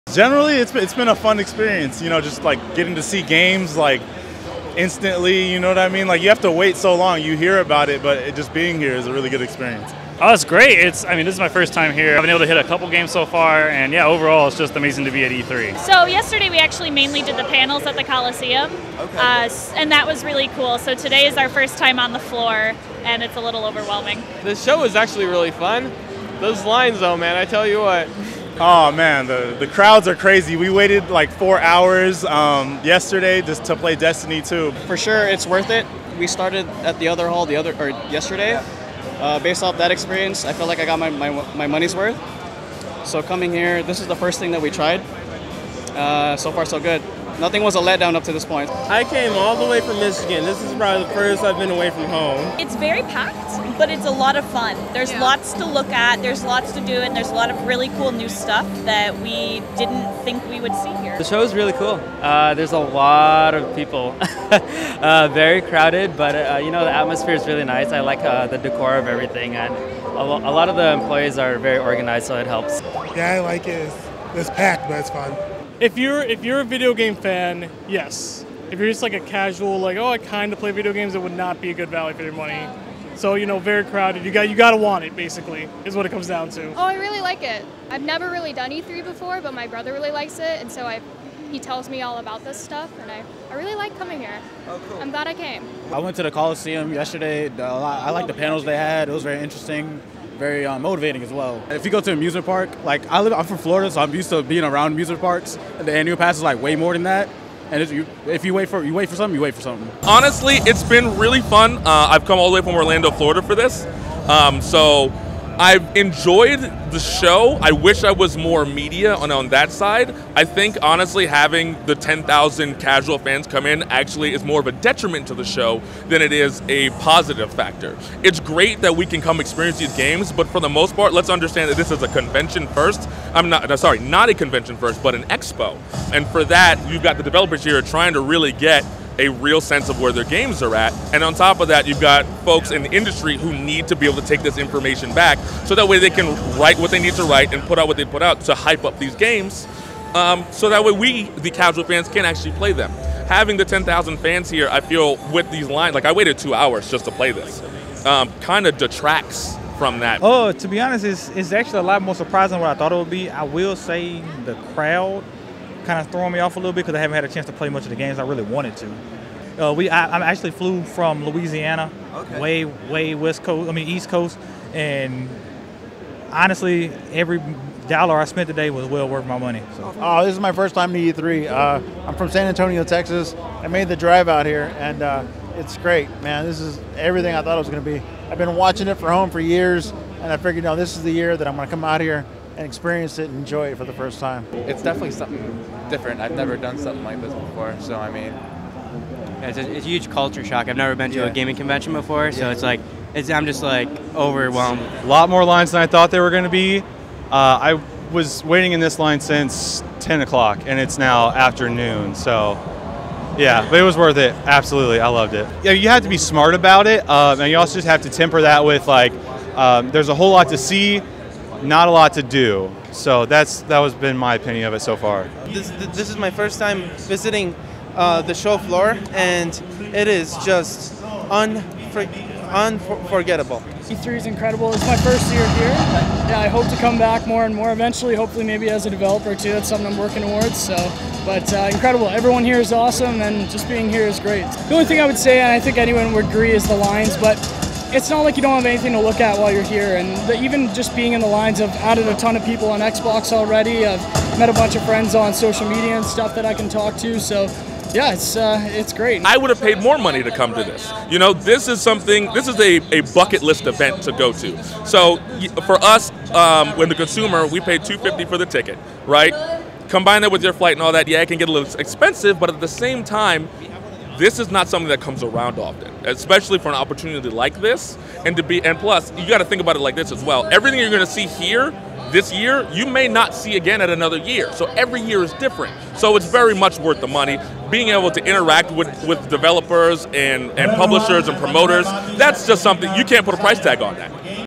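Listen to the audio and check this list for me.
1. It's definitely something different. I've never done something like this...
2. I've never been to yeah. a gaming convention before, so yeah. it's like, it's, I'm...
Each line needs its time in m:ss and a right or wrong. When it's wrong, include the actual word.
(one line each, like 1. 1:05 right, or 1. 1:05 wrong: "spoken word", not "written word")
1. 3:14 right
2. 3:20 right.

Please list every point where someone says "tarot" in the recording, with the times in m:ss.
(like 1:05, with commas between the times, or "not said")
not said.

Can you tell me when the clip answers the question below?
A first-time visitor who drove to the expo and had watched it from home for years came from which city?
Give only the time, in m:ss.
3:02.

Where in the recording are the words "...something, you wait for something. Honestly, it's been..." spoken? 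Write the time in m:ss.
1:49.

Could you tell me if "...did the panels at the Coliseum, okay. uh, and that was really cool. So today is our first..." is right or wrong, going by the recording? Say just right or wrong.
right.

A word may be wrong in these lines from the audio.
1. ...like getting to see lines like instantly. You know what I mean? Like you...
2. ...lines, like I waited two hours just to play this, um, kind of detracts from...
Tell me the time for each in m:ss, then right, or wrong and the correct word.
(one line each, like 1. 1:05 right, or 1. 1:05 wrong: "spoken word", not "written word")
1. 0:02 wrong: "games", not "lines"
2. 2:35 right.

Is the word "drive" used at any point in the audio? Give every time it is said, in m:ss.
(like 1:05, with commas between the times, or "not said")
3:03.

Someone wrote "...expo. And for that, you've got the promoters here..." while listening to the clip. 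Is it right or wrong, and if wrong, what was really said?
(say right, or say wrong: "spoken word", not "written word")
wrong: "developers", not "promoters".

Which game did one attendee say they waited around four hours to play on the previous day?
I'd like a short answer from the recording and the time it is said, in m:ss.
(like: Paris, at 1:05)
Destiny 2, at 0:33.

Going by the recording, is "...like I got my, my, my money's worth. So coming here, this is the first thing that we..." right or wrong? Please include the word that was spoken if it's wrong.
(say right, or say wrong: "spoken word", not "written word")
right.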